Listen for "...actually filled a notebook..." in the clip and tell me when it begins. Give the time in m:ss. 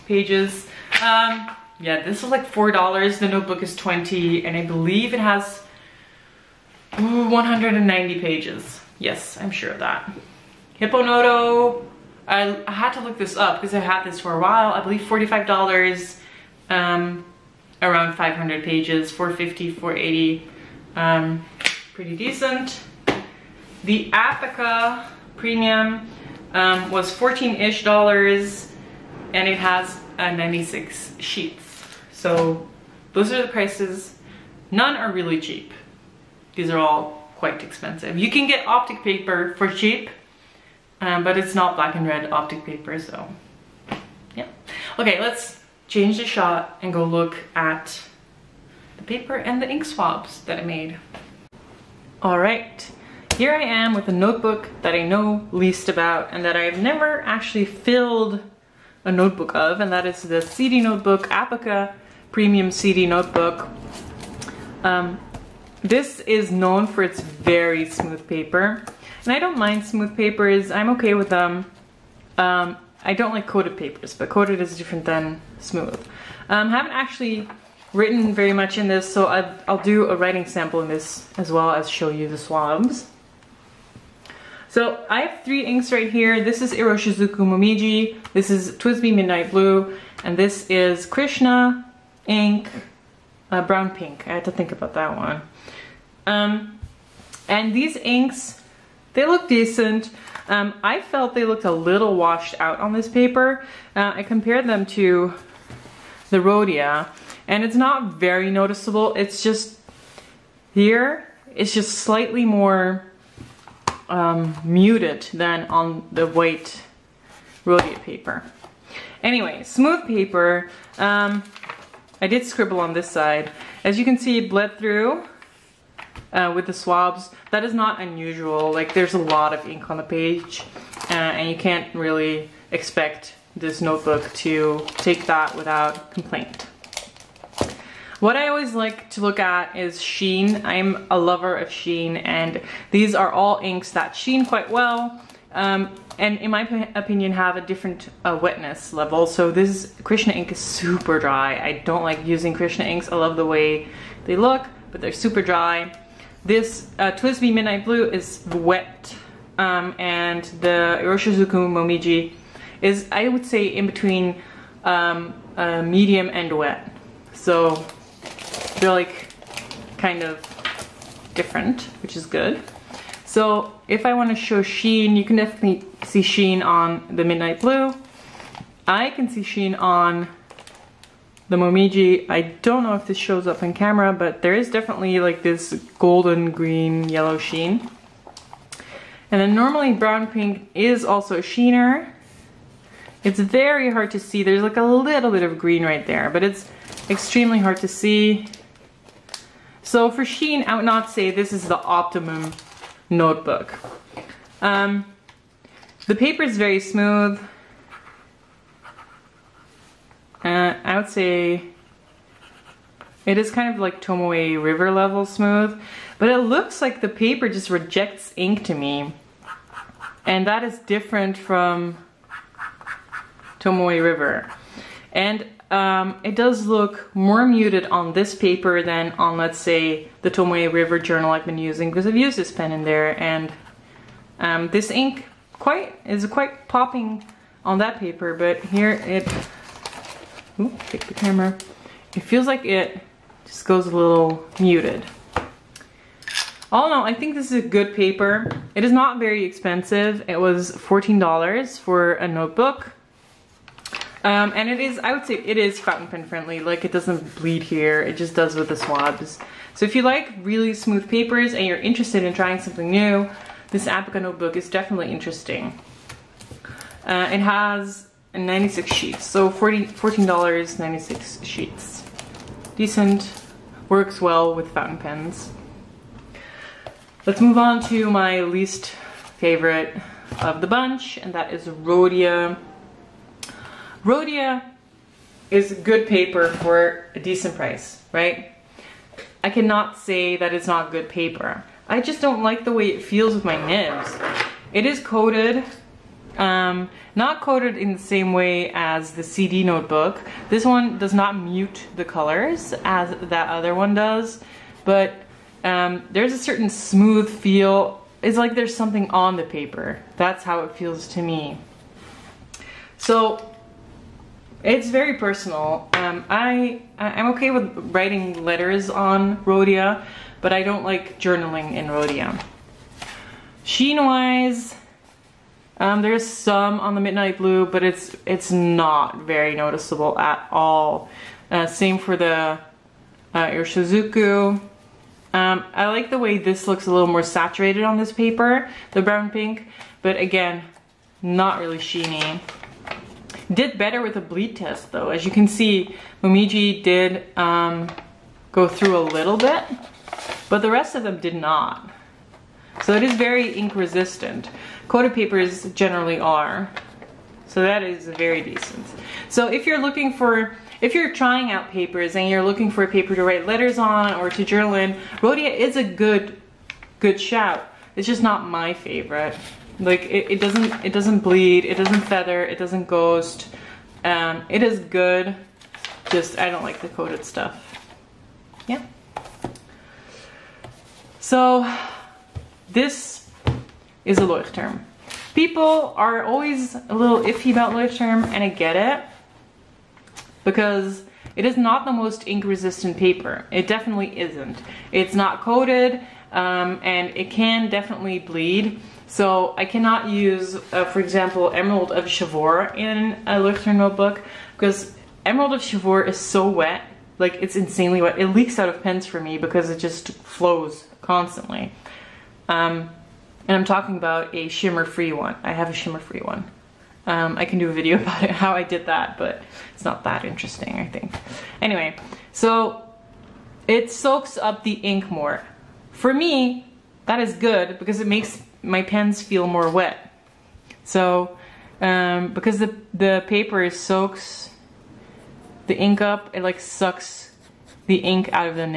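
0:57.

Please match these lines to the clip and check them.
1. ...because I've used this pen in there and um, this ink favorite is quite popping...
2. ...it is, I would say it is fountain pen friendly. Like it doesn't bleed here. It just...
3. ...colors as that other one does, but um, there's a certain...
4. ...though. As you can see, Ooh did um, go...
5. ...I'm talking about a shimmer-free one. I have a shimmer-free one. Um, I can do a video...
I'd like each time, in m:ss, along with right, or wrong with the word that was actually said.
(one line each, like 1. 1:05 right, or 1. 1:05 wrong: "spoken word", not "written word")
1. 3:51 wrong: "quite", not "favorite"
2. 4:14 right
3. 5:02 right
4. 5:44 wrong: "Momiji", not "Ooh"
5. 6:53 right.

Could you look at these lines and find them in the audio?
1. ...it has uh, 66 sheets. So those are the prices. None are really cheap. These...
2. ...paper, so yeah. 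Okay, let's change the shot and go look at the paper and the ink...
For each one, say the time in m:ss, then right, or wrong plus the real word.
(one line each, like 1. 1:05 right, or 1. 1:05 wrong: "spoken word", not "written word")
1. 0:29 wrong: "96", not "66"
2. 0:42 right.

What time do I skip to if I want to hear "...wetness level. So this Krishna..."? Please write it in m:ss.
2:28.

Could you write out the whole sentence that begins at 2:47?
So they're like kind of different, which is good.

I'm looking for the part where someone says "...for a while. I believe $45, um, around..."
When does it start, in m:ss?
0:14.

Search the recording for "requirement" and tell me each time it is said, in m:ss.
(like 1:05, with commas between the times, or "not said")
not said.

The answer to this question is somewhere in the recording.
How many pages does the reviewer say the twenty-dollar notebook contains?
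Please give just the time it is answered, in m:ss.
0:07.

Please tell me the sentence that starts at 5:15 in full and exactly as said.
Um, I I'm okay with writing letters on Rhodia, but I don't like journaling in Rhodia.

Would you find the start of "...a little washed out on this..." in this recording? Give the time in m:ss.
1:41.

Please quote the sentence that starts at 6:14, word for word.
Um, it is good, just I don't like the coated stuff.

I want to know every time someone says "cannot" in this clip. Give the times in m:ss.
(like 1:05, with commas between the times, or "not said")
4:49, 6:39.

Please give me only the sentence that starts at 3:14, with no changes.
There's like a little bit of green right there, but it's extremely hard to see.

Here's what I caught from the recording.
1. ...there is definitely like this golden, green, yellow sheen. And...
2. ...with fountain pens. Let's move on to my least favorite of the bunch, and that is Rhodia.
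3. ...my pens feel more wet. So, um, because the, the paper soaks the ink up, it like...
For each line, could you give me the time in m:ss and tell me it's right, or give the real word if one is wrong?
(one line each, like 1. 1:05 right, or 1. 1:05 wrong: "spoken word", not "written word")
1. 3:04 right
2. 4:34 right
3. 7:08 right.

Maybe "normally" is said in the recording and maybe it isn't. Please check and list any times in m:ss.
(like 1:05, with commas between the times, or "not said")
3:09.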